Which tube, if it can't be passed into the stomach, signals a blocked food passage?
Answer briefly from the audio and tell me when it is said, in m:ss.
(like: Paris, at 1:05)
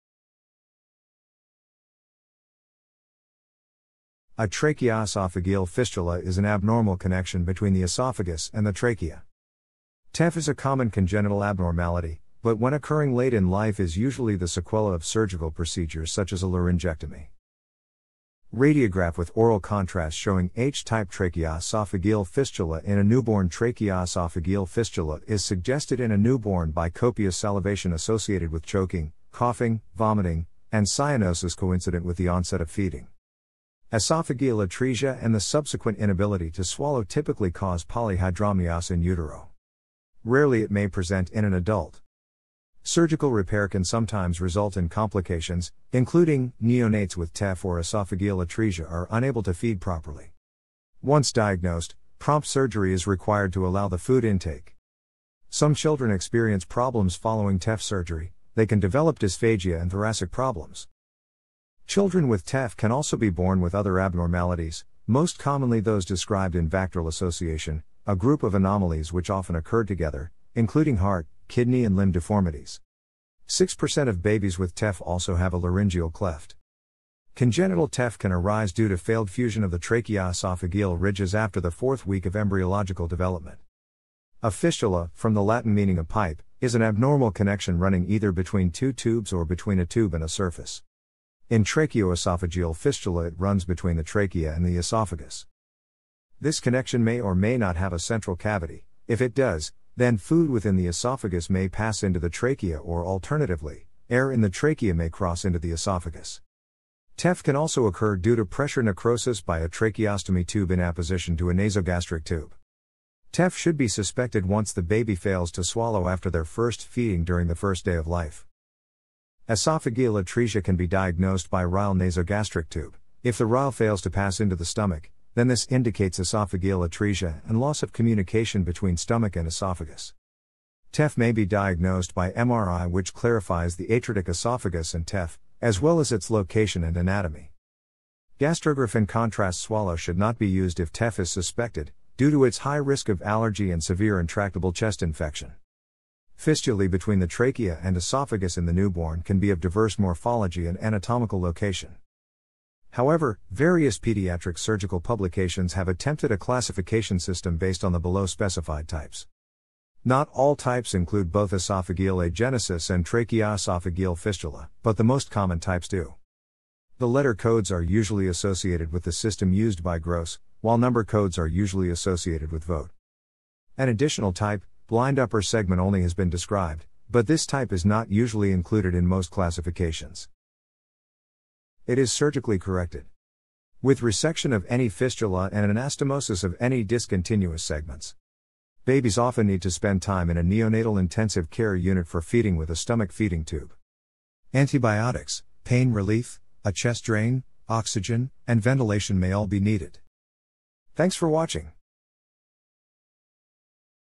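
Ryle nasogastric tube, at 2:01.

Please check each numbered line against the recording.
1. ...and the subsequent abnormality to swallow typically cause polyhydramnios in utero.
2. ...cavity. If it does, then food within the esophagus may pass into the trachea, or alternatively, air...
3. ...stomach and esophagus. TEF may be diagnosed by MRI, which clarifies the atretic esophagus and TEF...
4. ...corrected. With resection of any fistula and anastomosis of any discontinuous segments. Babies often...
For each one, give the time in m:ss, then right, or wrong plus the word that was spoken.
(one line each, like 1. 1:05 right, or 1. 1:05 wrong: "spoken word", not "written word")
1. 0:35 wrong: "inability", not "abnormality"
2. 1:38 right
3. 2:08 right
4. 3:02 right.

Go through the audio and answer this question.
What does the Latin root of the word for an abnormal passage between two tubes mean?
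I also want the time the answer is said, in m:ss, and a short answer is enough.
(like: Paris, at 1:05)
a pipe, at 1:25.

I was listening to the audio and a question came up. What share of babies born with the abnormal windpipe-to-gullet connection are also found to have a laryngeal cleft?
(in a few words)
6%.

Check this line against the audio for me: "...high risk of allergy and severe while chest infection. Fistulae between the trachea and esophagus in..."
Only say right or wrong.
wrong.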